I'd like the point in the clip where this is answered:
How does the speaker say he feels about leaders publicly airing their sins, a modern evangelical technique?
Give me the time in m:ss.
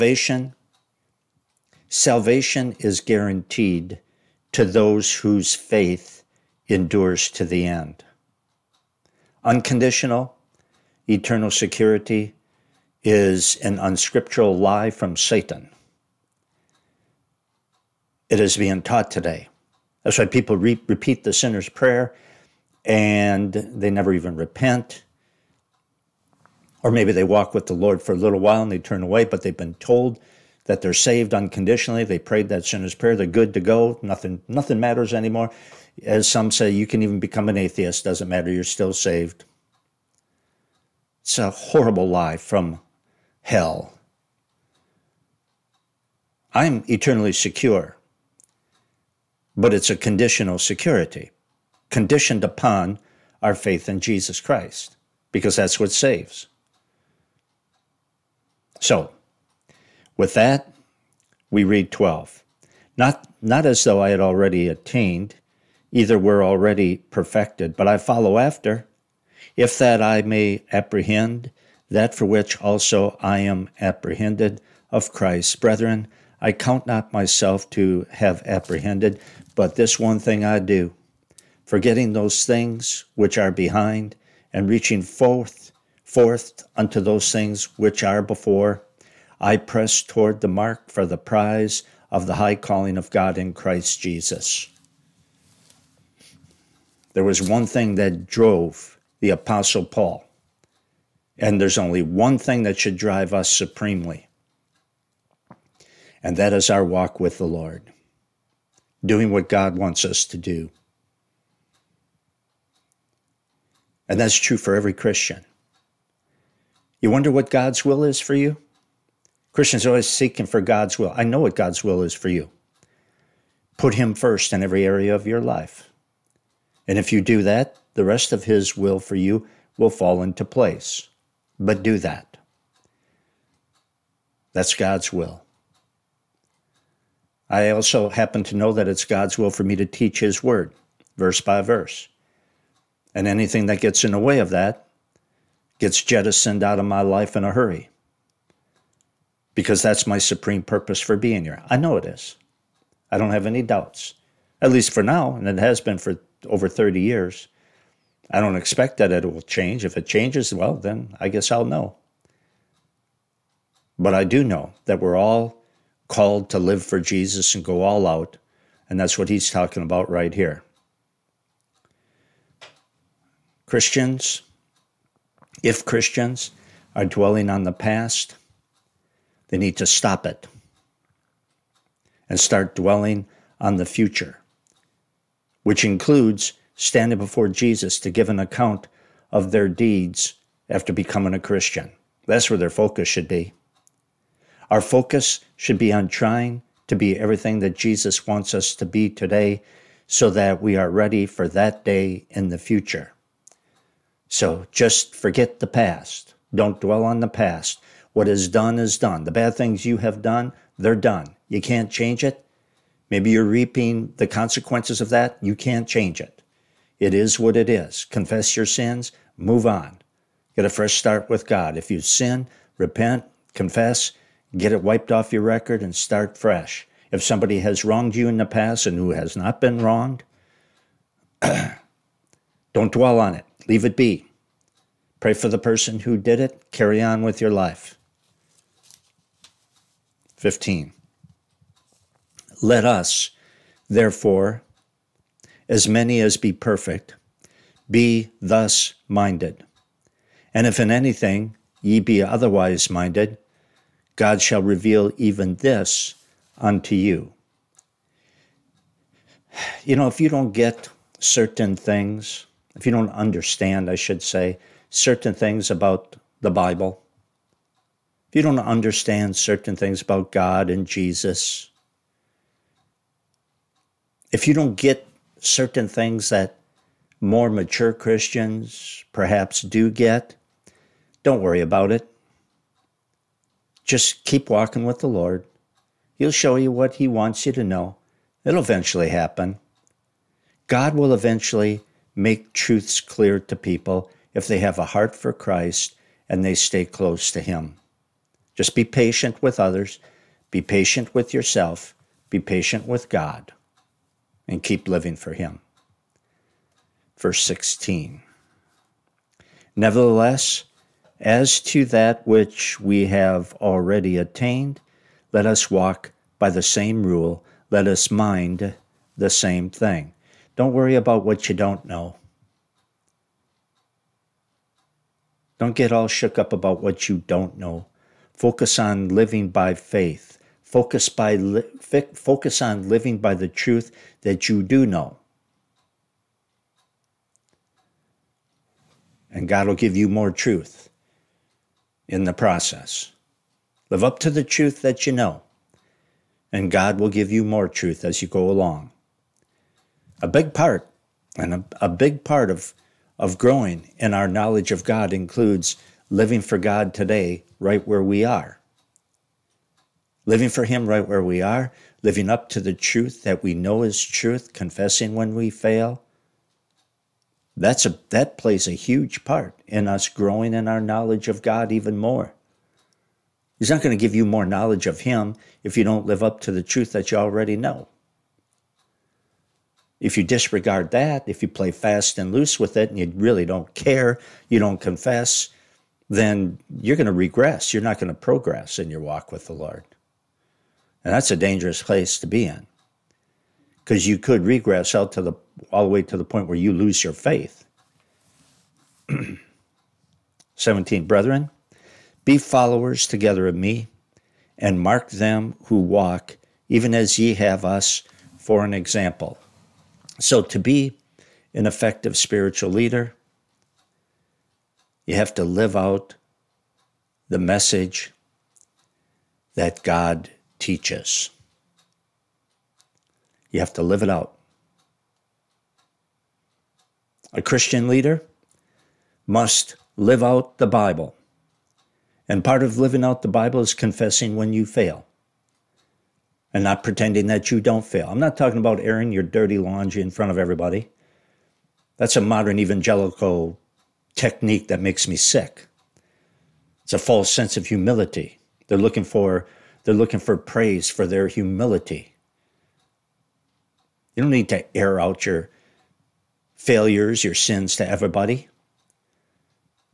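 7:24.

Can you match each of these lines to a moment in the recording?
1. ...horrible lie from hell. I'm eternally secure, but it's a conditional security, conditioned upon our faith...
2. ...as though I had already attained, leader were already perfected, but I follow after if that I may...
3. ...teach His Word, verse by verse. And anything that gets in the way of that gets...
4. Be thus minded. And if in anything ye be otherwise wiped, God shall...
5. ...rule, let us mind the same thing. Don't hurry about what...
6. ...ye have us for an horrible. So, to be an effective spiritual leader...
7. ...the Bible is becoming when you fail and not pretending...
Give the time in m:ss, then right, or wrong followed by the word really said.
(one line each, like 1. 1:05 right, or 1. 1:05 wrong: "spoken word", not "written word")
1. 0:41 right
2. 1:03 wrong: "either", not "leader"
3. 2:19 right
4. 4:07 wrong: "minded", not "wiped"
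5. 5:17 wrong: "worry", not "hurry"
6. 6:47 wrong: "example", not "horrible"
7. 7:13 wrong: "confessing", not "becoming".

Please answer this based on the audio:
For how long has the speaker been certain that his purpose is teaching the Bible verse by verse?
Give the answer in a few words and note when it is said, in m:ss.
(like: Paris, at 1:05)
over 30 years, at 2:36.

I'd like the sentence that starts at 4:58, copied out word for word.
Just be patient with others, be patient with yourself, be patient with God and keep living for Him.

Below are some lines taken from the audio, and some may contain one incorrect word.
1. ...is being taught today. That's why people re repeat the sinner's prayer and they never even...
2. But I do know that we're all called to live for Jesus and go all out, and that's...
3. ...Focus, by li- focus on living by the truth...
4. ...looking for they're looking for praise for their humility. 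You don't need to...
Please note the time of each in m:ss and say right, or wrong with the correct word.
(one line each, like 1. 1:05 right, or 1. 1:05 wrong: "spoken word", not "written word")
1. 0:18 right
2. 2:43 right
3. 5:30 right
4. 7:28 right.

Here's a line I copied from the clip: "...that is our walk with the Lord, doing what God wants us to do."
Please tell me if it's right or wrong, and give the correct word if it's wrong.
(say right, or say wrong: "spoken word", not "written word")
right.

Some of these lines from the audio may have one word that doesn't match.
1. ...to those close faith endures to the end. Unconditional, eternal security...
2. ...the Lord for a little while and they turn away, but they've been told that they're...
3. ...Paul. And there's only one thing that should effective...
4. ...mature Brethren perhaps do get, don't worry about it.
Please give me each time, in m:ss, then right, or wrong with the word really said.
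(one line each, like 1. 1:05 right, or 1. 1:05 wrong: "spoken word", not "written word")
1. 0:04 wrong: "whose", not "close"
2. 0:27 right
3. 1:39 wrong: "drive", not "effective"
4. 4:37 wrong: "Christians", not "Brethren".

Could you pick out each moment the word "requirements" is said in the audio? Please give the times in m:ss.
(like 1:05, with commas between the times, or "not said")
not said.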